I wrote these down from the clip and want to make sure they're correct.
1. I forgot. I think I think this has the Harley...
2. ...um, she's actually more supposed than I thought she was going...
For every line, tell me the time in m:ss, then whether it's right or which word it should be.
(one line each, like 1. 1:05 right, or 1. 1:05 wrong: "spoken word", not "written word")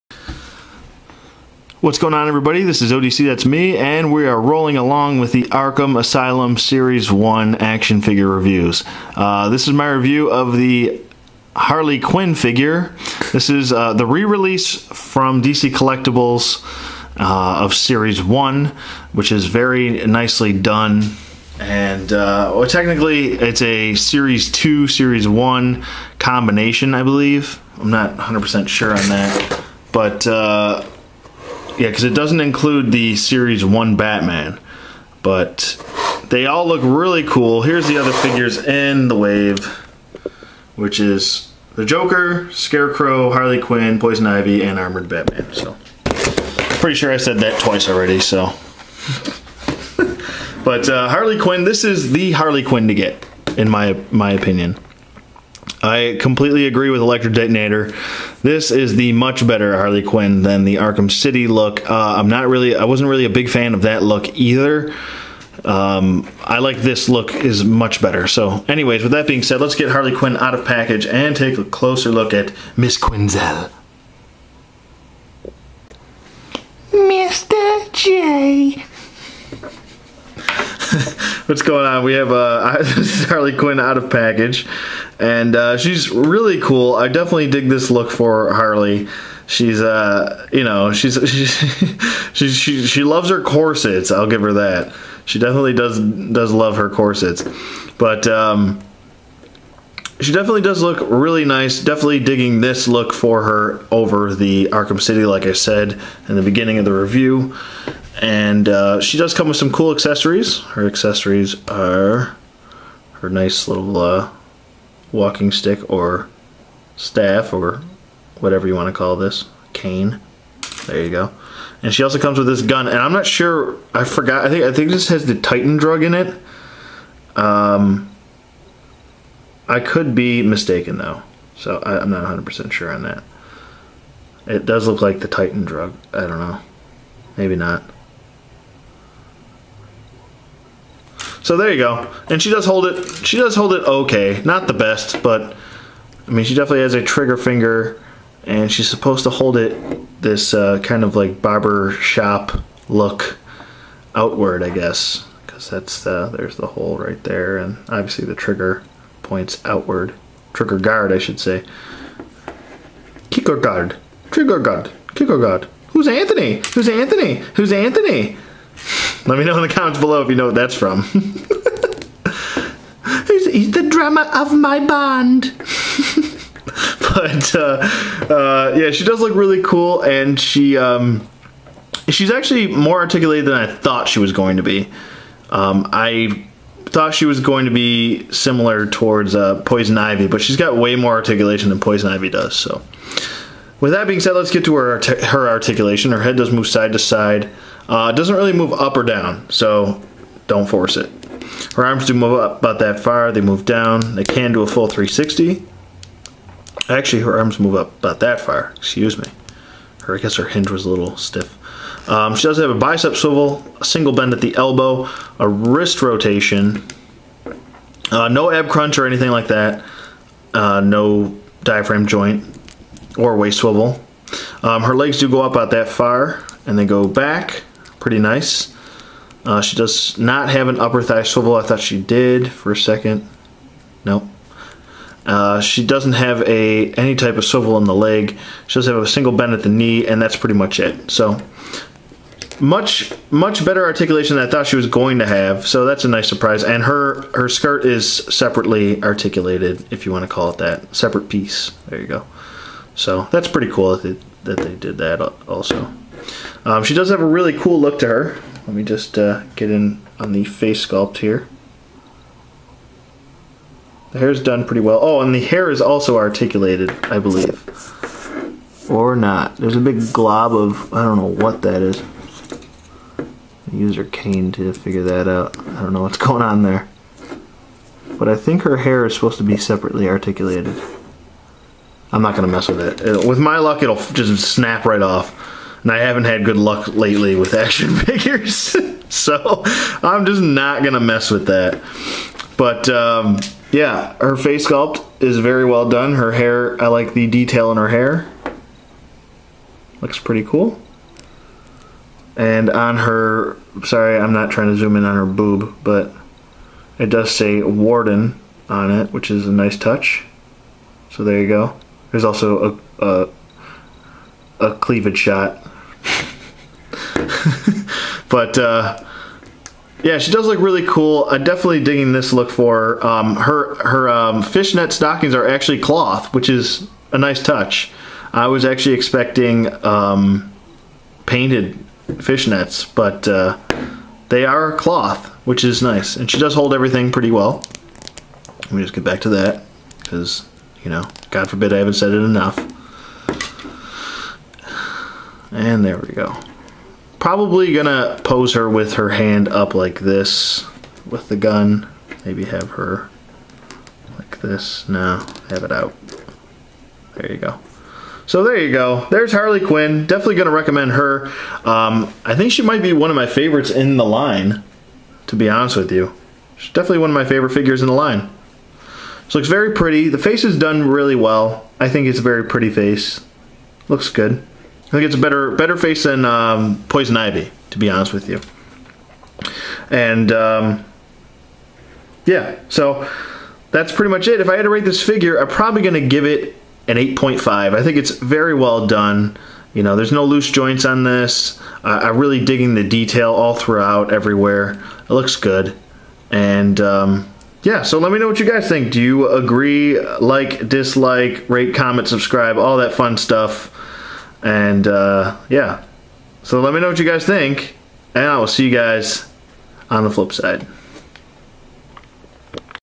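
1. 2:03 wrong: "Titan", not "Harley"
2. 3:00 wrong: "articulated", not "supposed".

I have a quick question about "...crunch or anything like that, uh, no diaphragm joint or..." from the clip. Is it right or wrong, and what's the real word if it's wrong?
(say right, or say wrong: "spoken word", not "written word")
right.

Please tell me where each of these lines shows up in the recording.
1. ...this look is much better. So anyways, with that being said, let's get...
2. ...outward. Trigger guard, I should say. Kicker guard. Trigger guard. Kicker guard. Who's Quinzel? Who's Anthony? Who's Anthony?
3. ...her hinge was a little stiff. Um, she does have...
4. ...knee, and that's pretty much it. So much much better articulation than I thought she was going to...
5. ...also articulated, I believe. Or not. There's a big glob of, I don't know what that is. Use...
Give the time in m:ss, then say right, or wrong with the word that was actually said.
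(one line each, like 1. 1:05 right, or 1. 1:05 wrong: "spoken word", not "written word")
1. 1:06 right
2. 2:39 wrong: "Anthony", not "Quinzel"
3. 3:30 right
4. 3:59 right
5. 4:25 right.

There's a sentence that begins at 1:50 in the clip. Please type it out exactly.
Her accessories are her nice little uh, walking stick or staff or whatever you want to call this, cane.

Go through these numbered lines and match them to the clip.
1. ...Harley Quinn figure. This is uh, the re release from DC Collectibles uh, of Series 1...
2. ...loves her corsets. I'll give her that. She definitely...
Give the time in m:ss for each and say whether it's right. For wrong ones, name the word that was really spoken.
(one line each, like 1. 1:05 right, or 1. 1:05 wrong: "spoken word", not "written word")
1. 0:11 right
2. 1:33 right.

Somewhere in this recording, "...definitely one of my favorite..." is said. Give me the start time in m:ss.
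6:06.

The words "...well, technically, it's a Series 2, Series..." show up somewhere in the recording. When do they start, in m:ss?
0:22.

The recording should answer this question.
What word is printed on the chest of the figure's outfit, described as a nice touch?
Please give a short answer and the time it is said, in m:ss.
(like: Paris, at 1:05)
Warden, at 5:07.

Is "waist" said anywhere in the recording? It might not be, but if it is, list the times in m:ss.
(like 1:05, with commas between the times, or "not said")
3:43.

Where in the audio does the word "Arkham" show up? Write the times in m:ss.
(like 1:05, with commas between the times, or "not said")
0:05, 1:00, 1:44.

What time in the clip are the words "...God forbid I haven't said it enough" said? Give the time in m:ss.
5:41.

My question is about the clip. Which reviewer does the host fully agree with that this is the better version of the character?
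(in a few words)
Electric Detonator.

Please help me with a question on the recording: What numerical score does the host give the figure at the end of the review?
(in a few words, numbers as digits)
8.5.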